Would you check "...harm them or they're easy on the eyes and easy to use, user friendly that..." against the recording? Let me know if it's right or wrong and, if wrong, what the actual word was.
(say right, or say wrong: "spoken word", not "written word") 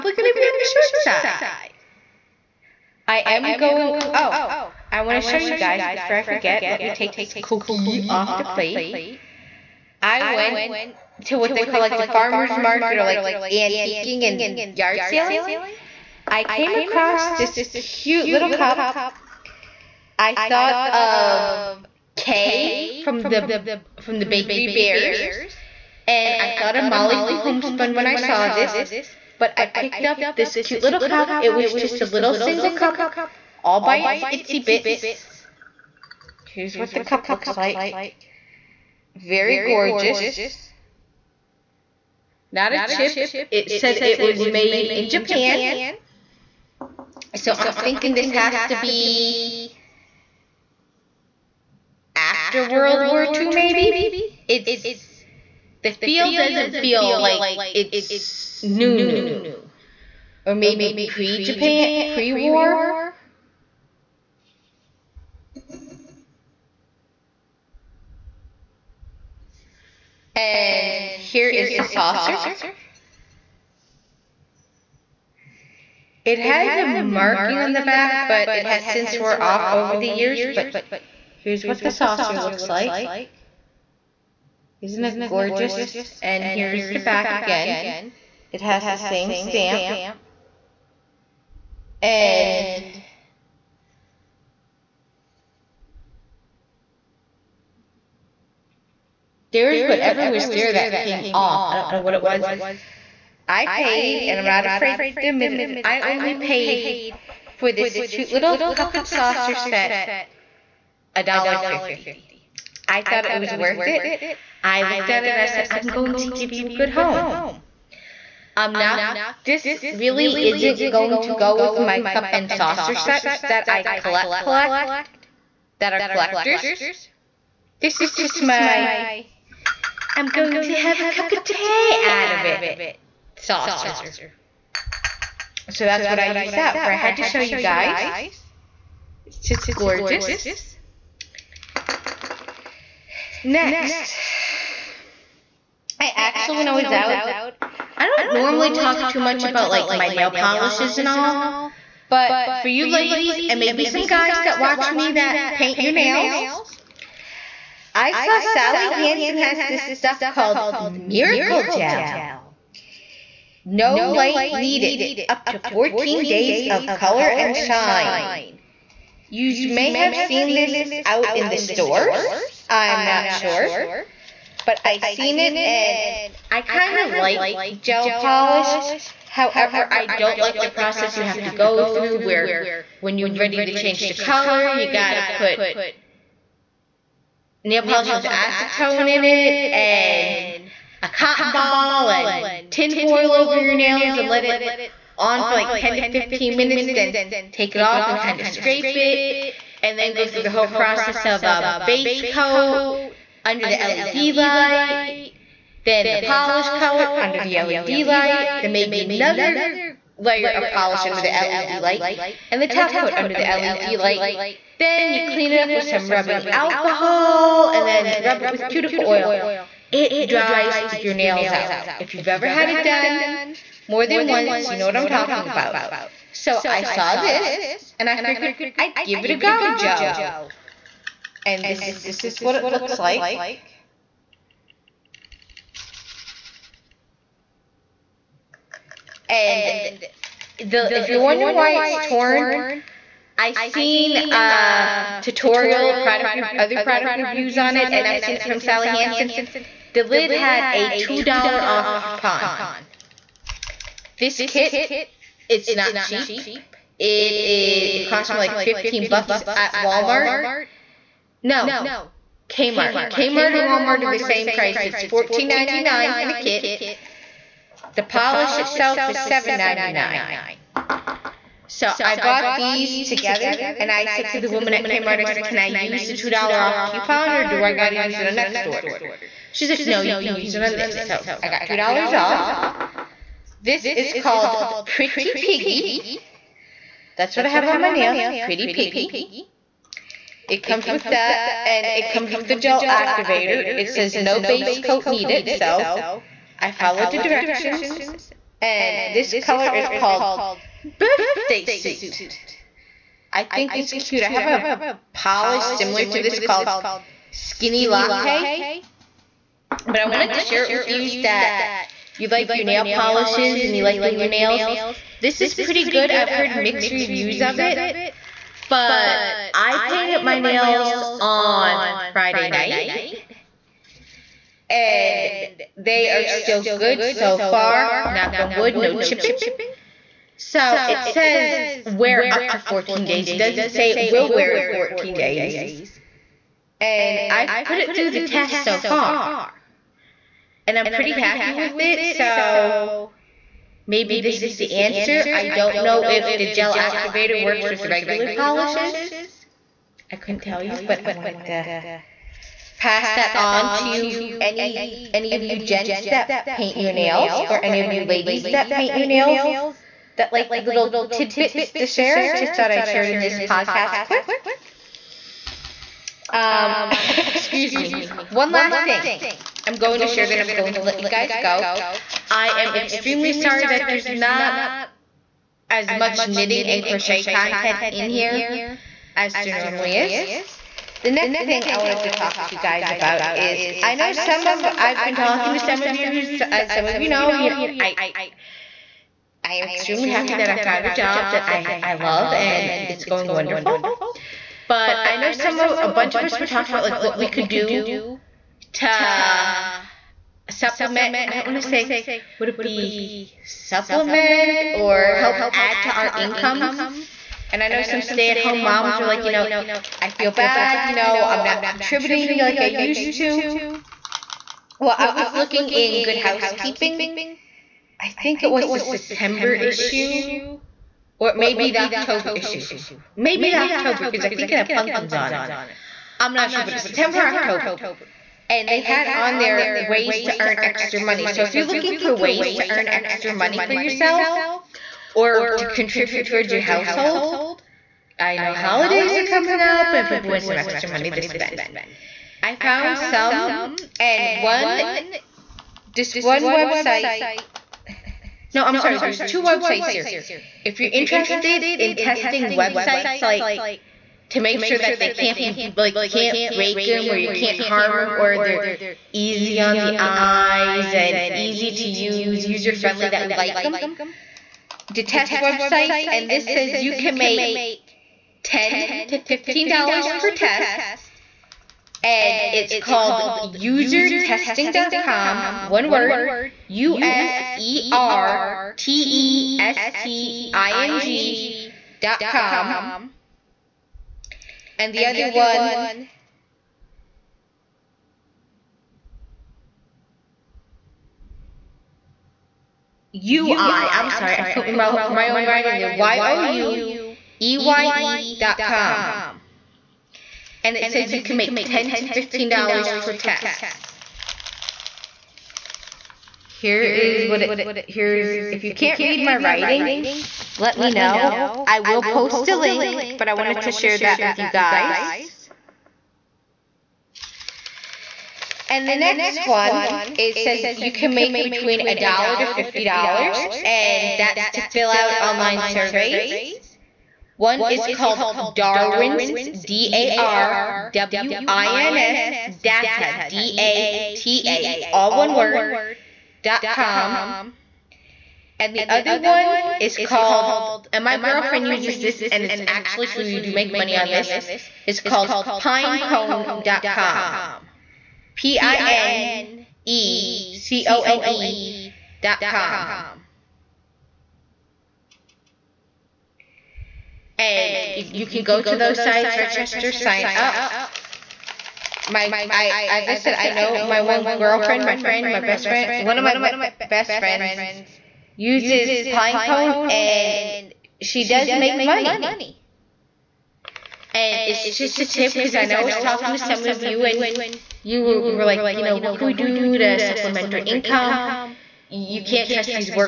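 right.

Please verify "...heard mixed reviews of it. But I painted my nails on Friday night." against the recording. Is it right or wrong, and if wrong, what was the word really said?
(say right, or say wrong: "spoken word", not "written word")
right.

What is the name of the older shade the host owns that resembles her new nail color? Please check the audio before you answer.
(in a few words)
Skinny Latte.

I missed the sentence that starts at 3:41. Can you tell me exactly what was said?
If you've ever had it done more than once, you know what I'm talking about.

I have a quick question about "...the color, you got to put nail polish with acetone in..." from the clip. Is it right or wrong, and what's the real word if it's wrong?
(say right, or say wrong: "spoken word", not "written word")
right.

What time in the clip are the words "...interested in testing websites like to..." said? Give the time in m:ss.
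7:30.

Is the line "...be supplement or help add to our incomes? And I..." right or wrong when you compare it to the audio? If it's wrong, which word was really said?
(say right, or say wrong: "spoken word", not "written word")
right.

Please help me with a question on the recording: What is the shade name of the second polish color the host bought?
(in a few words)
Birthday Suit.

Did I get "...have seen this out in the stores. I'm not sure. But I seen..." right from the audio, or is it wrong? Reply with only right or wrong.
right.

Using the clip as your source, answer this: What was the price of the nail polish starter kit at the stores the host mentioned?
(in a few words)
$14.99.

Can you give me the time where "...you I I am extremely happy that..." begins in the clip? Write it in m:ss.
6:27.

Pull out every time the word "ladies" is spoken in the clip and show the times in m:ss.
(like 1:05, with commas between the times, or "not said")
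2:32, 5:58.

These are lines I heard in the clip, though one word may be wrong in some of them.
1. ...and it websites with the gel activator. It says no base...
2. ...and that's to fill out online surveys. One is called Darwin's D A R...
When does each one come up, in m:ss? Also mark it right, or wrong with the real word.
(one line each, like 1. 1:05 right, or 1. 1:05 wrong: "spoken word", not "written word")
1. 4:51 wrong: "comes", not "websites"
2. 8:43 right.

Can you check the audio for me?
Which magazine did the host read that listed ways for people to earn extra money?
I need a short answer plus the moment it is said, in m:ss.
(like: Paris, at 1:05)
Good Housekeeping, at 6:56.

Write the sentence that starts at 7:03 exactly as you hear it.
Maybe the October, because I think it had pumpkins on it.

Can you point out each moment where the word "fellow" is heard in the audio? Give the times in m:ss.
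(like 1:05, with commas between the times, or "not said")
not said.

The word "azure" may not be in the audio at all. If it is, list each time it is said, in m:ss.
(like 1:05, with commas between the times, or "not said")
not said.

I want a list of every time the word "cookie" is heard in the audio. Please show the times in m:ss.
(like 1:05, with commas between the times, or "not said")
0:07.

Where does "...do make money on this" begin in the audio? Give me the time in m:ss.
9:03.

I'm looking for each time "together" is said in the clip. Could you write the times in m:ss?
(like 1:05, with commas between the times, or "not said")
4:32.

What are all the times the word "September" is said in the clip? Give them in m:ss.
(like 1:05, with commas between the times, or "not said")
6:58, 7:06.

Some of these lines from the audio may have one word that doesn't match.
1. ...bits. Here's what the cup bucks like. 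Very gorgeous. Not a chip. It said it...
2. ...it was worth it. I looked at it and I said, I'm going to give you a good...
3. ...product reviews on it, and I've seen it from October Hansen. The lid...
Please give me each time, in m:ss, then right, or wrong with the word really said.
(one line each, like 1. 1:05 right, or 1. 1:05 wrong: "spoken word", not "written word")
1. 0:34 wrong: "looks", not "bucks"
2. 1:53 right
3. 4:06 wrong: "Sally", not "October".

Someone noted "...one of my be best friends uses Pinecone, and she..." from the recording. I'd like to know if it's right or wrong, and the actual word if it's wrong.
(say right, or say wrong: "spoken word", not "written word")
right.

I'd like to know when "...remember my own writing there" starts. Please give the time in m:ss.
8:14.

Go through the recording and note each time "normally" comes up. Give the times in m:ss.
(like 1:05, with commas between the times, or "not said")
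2:28, 6:19.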